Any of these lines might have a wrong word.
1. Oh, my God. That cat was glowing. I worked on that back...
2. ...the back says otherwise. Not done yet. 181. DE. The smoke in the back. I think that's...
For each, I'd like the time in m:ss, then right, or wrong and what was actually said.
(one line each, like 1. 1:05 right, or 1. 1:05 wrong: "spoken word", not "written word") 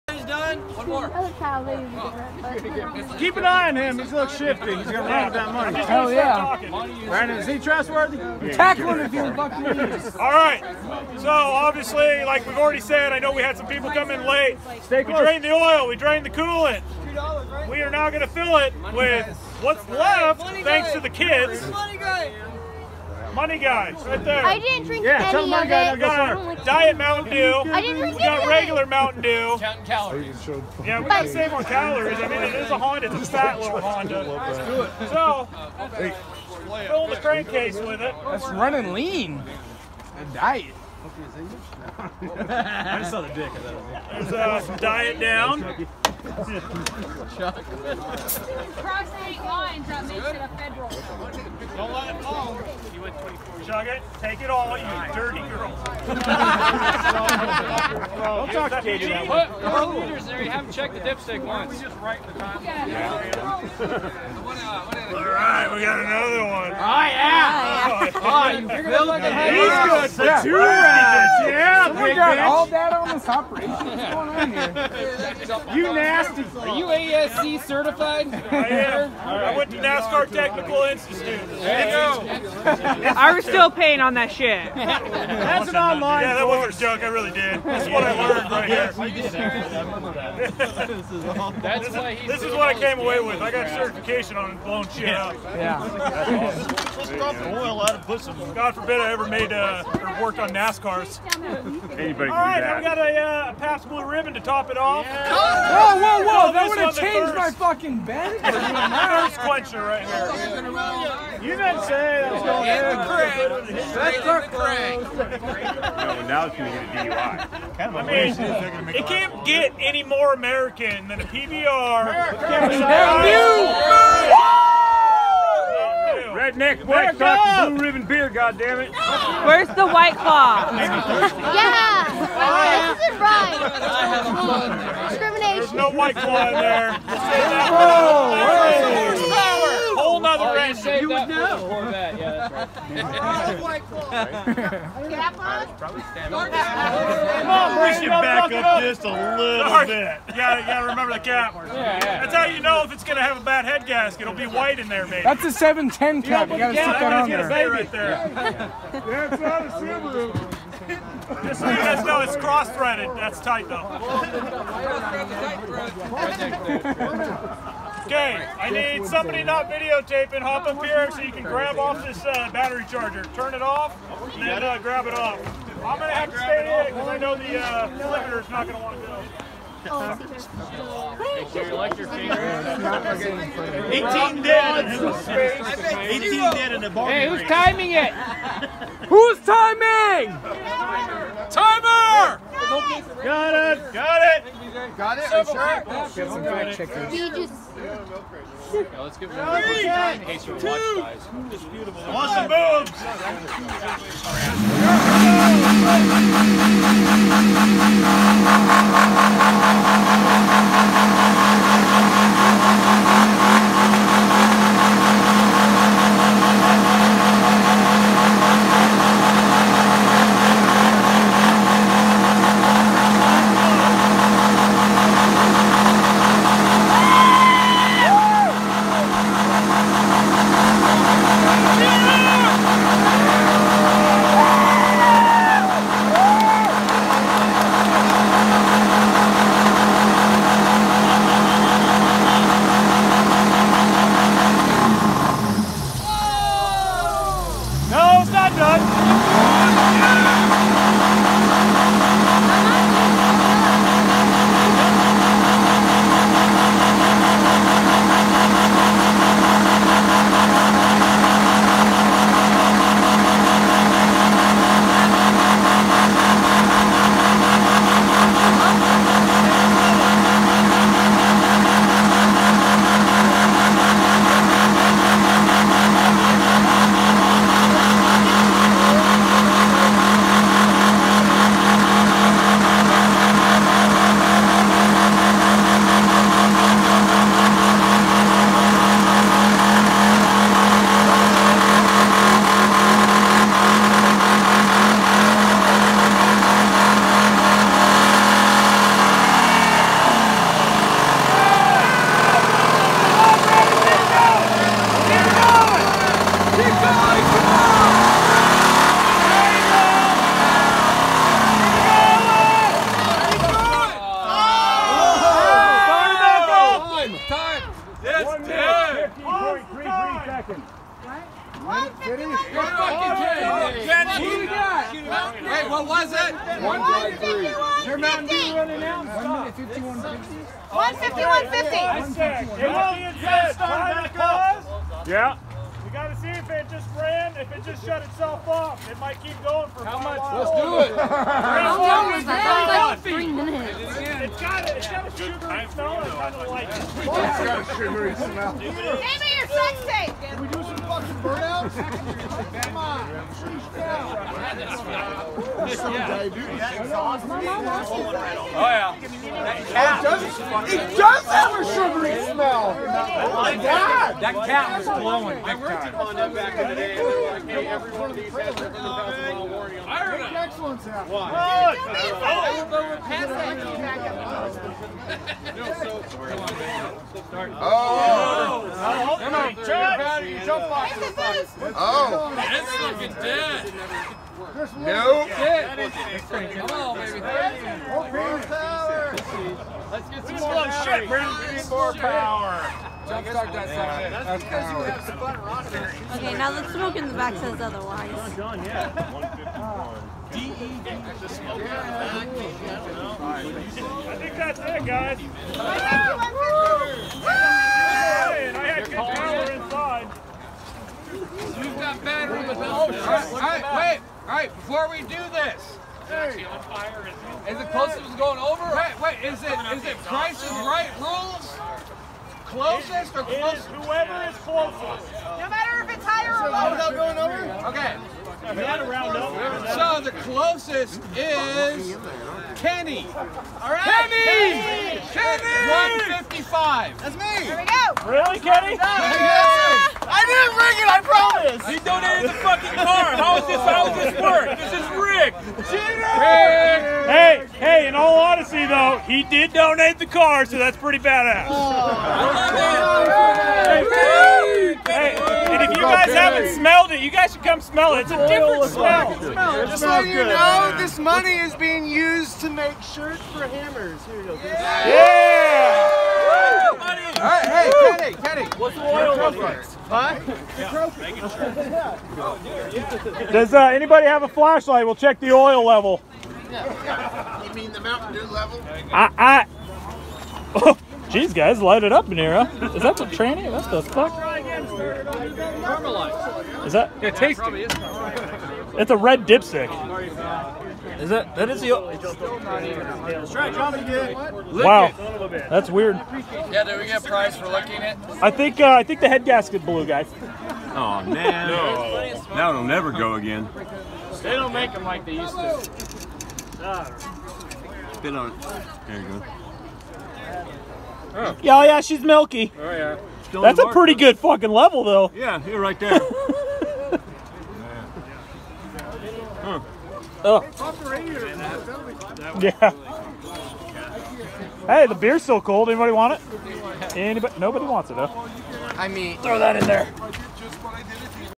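1. 6:02 right
2. 6:37 wrong: "151", not "181".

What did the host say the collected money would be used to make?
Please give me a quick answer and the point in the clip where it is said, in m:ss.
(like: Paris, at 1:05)
shirts, at 7:42.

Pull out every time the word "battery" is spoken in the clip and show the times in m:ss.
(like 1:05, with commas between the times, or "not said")
2:52, 6:52.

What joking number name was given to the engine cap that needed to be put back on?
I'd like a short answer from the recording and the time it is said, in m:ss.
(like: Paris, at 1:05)
710 cap, at 2:35.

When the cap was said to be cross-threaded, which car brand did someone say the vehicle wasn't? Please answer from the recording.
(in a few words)
Subaru.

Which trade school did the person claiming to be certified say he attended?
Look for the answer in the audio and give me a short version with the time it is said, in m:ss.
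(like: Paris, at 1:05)
NASCAR Technical Institute, at 1:19.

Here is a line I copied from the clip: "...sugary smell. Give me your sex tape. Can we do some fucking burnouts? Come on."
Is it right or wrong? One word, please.
right.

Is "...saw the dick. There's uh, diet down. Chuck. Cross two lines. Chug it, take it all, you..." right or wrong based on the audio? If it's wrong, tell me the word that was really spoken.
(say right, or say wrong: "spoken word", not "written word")
wrong: "eight", not "two".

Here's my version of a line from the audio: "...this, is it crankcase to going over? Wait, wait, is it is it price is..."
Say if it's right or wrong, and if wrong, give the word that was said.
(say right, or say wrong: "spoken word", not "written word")
wrong: "close", not "crankcase".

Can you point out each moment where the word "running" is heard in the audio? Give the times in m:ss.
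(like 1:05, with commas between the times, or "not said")
0:38.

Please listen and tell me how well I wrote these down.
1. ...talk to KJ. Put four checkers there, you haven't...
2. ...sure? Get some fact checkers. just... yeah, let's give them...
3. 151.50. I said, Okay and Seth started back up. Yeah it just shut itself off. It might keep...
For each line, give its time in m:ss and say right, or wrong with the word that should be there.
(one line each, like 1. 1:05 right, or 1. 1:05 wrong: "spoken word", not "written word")
1. 0:58 wrong: "liters", not "checkers"
2. 3:15 right
3. 5:30 wrong: "Kenny", not "Okay".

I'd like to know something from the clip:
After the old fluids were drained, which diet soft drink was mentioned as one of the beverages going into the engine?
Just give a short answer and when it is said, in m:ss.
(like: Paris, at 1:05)
Diet Mountain Dew, at 0:26.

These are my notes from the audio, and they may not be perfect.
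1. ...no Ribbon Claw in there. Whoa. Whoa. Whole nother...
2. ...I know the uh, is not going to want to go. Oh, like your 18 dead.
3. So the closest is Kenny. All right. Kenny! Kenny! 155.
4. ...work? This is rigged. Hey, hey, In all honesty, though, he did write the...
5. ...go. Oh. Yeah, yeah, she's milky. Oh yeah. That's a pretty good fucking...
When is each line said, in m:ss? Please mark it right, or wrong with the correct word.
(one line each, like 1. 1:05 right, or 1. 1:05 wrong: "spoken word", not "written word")
1. 2:15 wrong: "White", not "Ribbon"
2. 2:57 right
3. 7:09 right
4. 7:24 wrong: "donate", not "write"
5. 8:29 right.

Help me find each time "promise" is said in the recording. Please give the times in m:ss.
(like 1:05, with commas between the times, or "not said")
7:21.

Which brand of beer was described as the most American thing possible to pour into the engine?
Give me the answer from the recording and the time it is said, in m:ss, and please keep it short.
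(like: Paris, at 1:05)
PBR, at 2:01.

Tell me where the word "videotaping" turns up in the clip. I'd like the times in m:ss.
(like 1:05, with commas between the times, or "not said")
2:49.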